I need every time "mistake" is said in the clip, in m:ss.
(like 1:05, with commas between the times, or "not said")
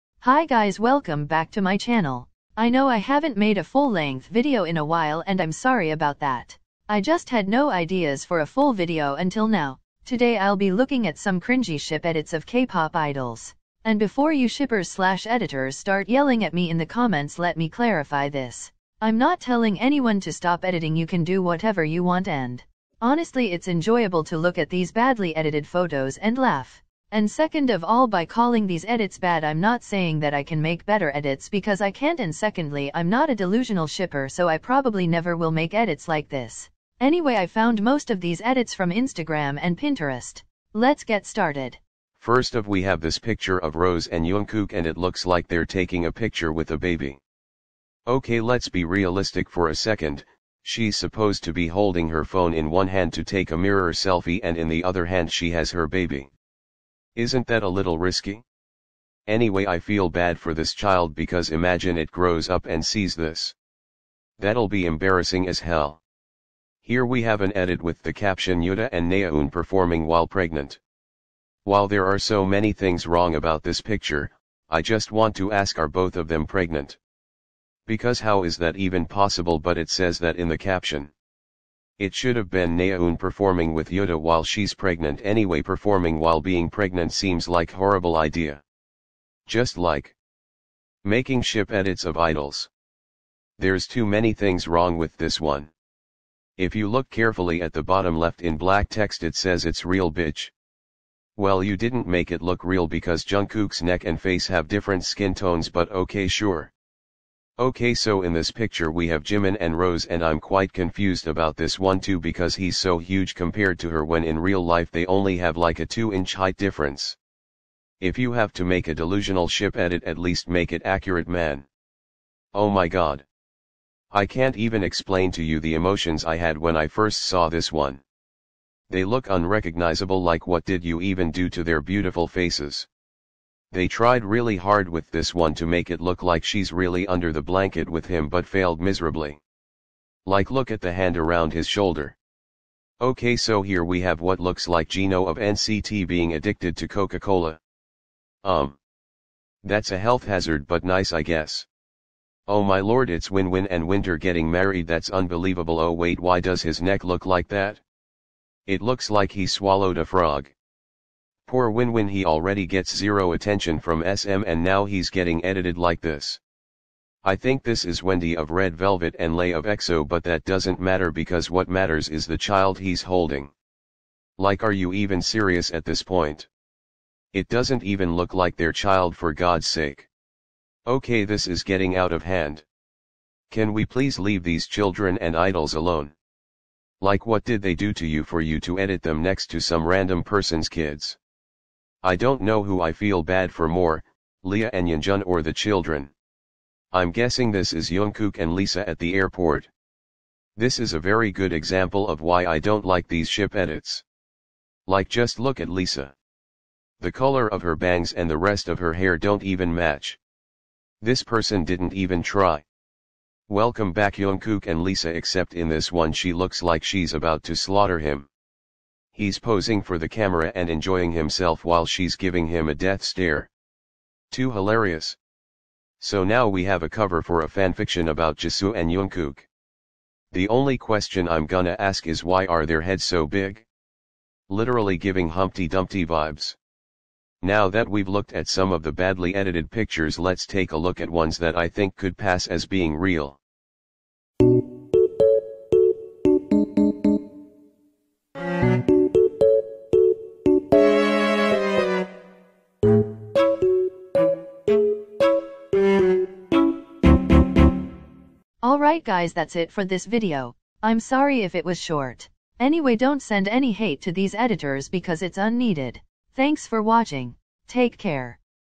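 not said.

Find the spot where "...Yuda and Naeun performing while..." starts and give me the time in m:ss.
1:08.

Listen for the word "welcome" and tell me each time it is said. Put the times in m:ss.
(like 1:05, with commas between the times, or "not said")
0:00, 3:33.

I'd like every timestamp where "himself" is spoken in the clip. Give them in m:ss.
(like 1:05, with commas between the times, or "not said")
3:41.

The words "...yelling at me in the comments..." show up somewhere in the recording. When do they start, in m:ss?
0:16.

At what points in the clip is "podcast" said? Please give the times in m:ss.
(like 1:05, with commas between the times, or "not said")
not said.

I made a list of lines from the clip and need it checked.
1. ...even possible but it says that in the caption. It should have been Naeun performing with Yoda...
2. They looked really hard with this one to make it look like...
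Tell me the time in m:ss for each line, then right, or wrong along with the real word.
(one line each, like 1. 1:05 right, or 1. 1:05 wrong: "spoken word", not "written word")
1. 1:18 right
2. 2:13 wrong: "tried", not "looked".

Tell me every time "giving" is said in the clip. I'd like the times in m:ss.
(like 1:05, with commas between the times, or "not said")
3:42, 3:54.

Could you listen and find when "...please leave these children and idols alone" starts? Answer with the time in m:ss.
3:03.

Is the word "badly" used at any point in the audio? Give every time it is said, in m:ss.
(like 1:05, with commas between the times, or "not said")
0:24, 3:58.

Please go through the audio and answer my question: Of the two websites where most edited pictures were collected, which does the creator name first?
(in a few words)
Instagram.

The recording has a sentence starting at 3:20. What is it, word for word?
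This is a very good example of why I don't like these ship edits.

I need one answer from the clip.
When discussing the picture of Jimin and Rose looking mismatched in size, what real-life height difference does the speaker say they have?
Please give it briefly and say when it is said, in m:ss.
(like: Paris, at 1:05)
2 inches, at 1:55.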